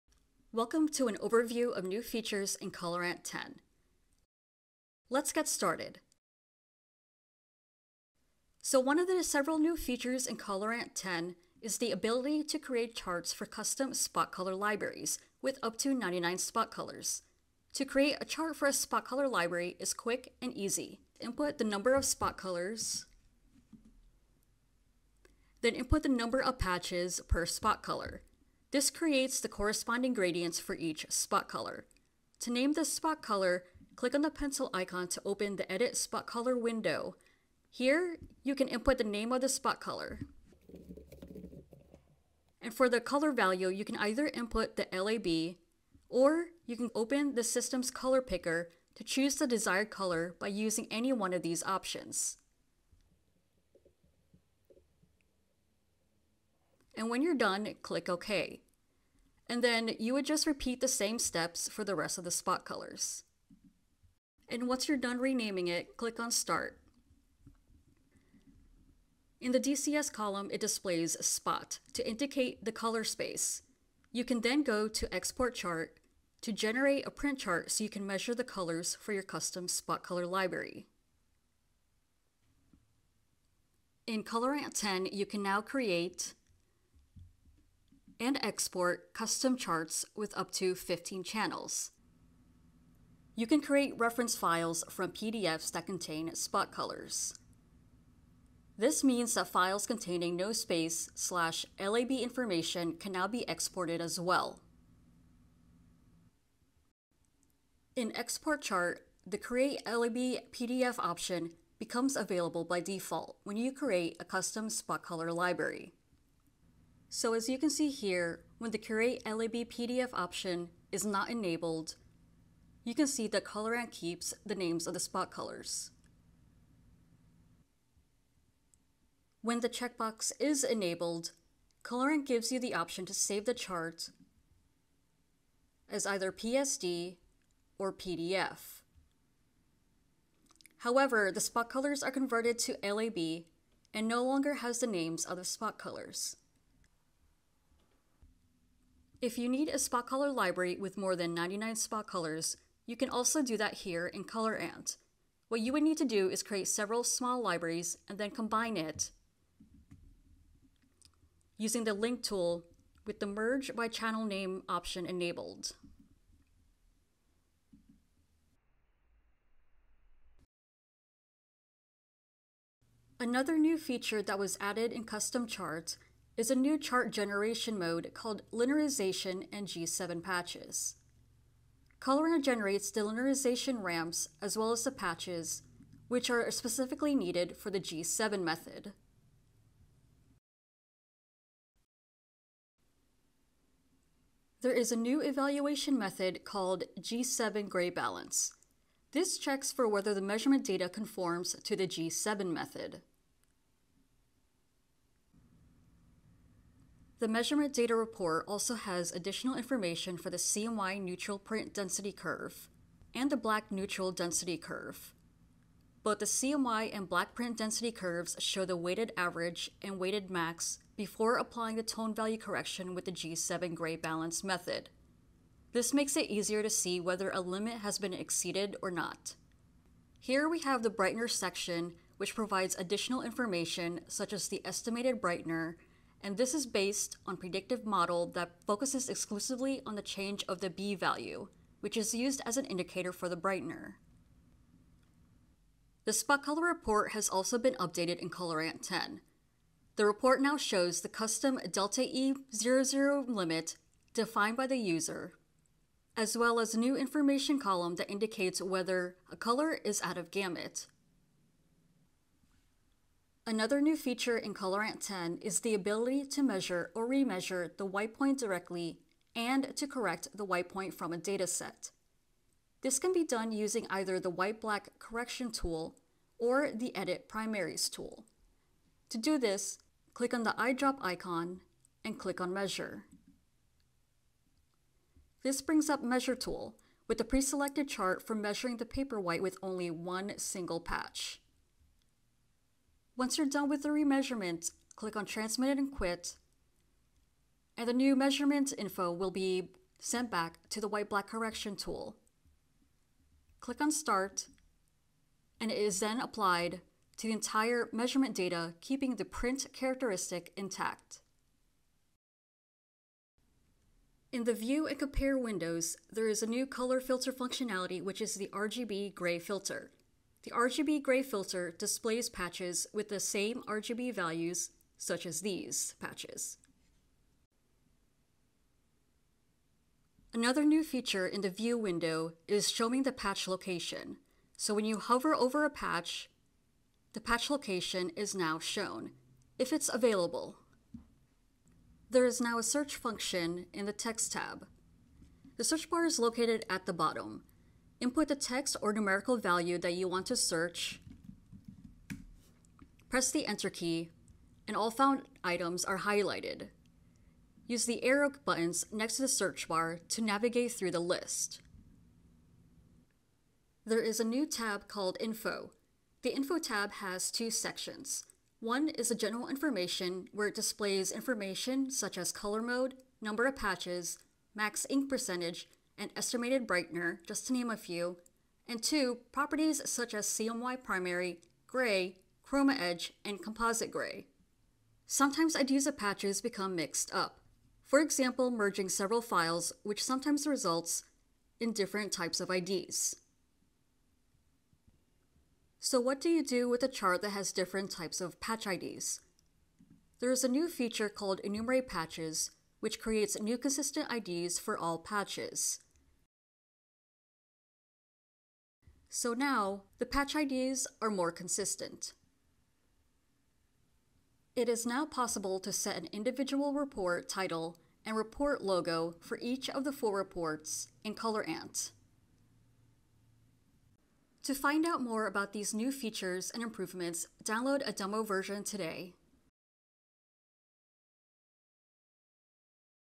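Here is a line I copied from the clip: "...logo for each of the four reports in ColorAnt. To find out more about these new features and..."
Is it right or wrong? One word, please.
right.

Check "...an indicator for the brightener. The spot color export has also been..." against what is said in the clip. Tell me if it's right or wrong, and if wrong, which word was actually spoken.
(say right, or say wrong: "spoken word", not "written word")
wrong: "report", not "export".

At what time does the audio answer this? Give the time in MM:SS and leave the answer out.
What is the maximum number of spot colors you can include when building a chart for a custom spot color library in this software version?
00:15.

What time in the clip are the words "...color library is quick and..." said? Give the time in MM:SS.
00:19.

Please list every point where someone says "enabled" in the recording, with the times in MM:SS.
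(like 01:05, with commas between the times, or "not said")
02:01, 02:10, 02:45.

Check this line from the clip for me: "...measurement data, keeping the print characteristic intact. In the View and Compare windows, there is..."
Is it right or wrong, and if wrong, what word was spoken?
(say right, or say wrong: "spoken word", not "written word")
right.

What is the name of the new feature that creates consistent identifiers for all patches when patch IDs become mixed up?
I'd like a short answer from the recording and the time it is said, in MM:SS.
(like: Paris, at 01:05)
Enumerate Patches, at 06:41.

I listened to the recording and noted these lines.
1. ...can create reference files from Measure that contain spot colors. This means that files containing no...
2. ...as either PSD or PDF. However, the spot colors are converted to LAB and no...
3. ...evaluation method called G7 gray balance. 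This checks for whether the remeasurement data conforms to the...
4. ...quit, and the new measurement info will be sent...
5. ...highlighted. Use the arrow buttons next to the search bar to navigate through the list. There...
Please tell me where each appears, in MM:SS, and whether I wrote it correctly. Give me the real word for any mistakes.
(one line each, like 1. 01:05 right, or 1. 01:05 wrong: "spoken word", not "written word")
1. 01:33 wrong: "PDFs", not "Measure"
2. 02:15 right
3. 03:15 wrong: "measurement", not "remeasurement"
4. 04:55 right
5. 05:55 right.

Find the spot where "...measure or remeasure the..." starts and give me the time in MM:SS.
04:26.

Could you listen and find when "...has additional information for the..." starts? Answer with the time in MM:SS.
03:28.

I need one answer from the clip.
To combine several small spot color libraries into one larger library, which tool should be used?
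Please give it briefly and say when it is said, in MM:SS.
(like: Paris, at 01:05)
link tool, at 02:41.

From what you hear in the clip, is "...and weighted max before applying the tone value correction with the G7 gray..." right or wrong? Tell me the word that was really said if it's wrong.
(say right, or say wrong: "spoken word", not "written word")
right.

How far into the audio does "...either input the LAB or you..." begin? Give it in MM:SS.
00:43.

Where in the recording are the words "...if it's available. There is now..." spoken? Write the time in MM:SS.
05:39.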